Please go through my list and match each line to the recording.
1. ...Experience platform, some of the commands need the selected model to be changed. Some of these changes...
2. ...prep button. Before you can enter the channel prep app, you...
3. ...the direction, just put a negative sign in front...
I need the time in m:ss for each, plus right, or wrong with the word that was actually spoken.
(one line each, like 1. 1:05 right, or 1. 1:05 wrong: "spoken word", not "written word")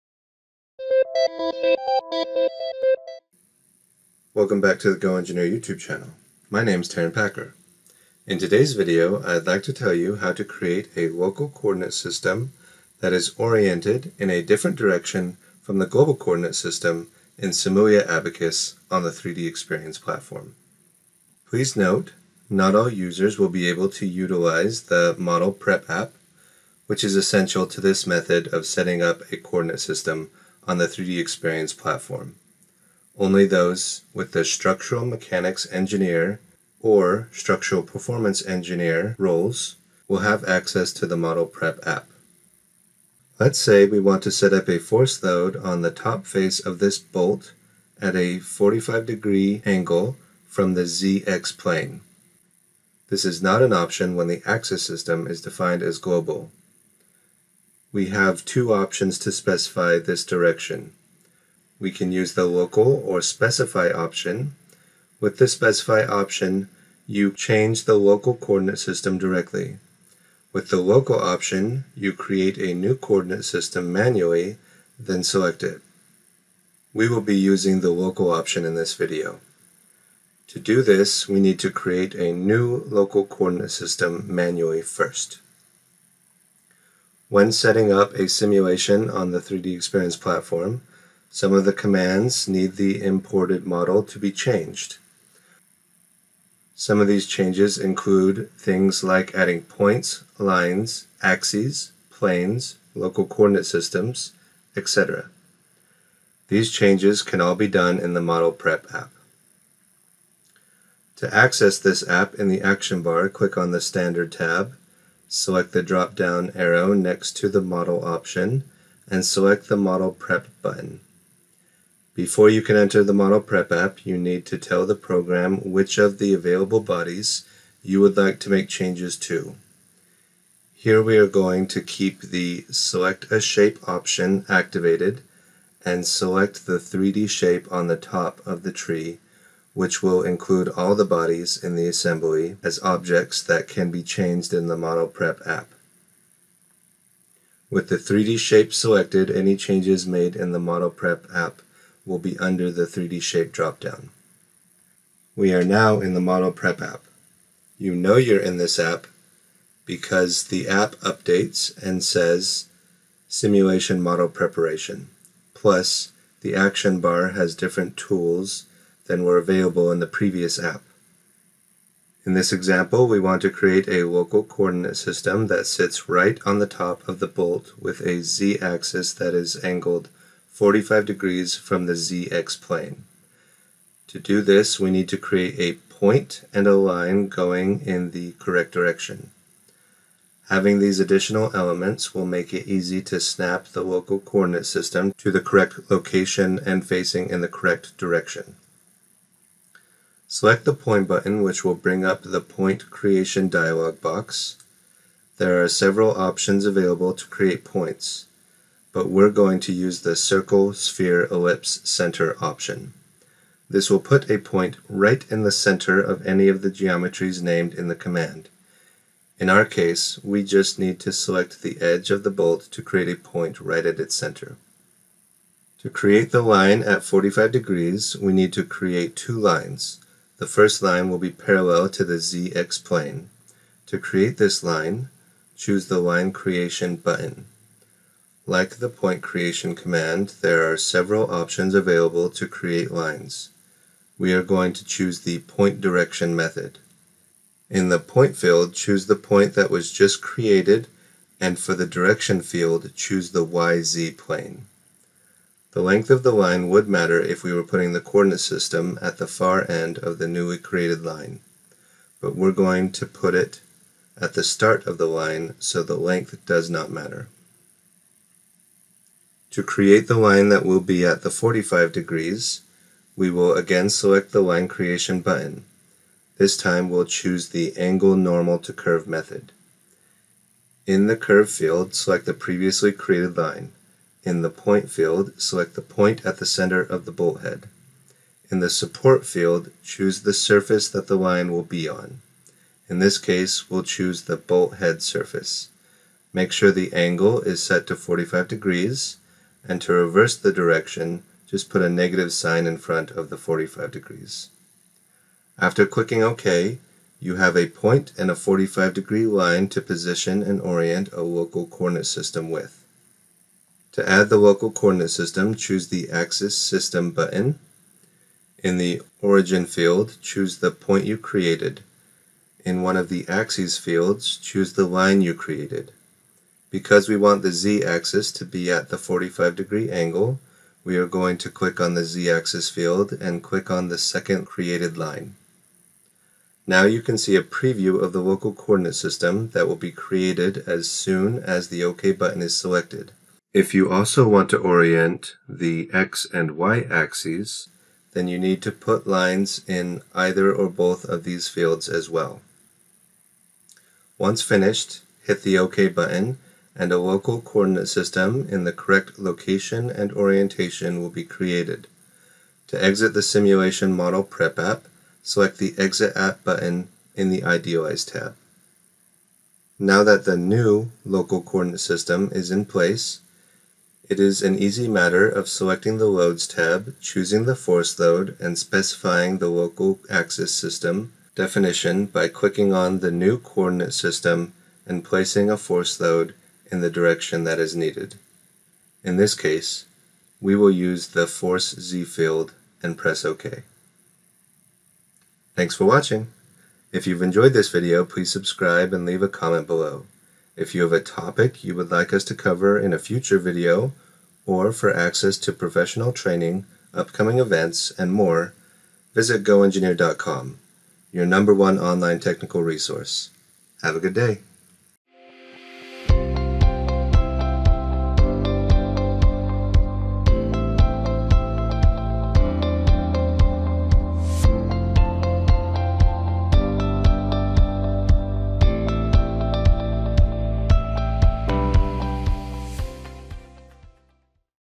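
1. 1:29 wrong: "imported", not "selected"
2. 2:00 wrong: "model", not "channel"
3. 5:00 right.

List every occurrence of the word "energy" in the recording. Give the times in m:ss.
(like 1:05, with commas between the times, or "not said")
not said.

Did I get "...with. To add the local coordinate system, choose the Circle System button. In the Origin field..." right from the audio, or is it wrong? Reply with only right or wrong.
wrong.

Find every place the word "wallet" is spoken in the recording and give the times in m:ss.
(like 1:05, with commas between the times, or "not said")
not said.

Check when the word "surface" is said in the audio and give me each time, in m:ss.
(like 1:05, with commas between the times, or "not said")
4:50, 4:55.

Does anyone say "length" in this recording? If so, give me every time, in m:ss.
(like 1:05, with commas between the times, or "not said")
4:15, 4:25.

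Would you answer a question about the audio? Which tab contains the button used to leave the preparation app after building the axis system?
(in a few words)
Idealize.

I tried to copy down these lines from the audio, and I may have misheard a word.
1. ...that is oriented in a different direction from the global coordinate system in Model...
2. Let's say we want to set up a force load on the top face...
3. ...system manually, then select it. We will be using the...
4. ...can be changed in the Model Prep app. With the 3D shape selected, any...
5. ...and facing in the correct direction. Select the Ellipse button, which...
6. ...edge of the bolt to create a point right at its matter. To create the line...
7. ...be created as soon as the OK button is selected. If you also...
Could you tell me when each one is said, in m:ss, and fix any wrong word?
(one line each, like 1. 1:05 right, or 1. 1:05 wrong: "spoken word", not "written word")
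1. 0:13 wrong: "Simulia", not "Model"
2. 0:43 right
3. 1:13 right
4. 2:23 right
5. 3:16 wrong: "Point", not "Ellipse"
6. 3:41 wrong: "center", not "matter"
7. 5:39 right.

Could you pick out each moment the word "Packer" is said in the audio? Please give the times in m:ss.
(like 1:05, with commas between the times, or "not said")
0:07.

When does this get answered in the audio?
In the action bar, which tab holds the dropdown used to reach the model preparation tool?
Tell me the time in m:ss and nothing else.
1:53.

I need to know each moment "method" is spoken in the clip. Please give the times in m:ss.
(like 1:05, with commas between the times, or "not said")
0:28, 4:06, 4:39.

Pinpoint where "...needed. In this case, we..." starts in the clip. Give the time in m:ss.
6:27.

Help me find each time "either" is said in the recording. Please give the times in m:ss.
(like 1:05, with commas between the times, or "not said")
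5:50.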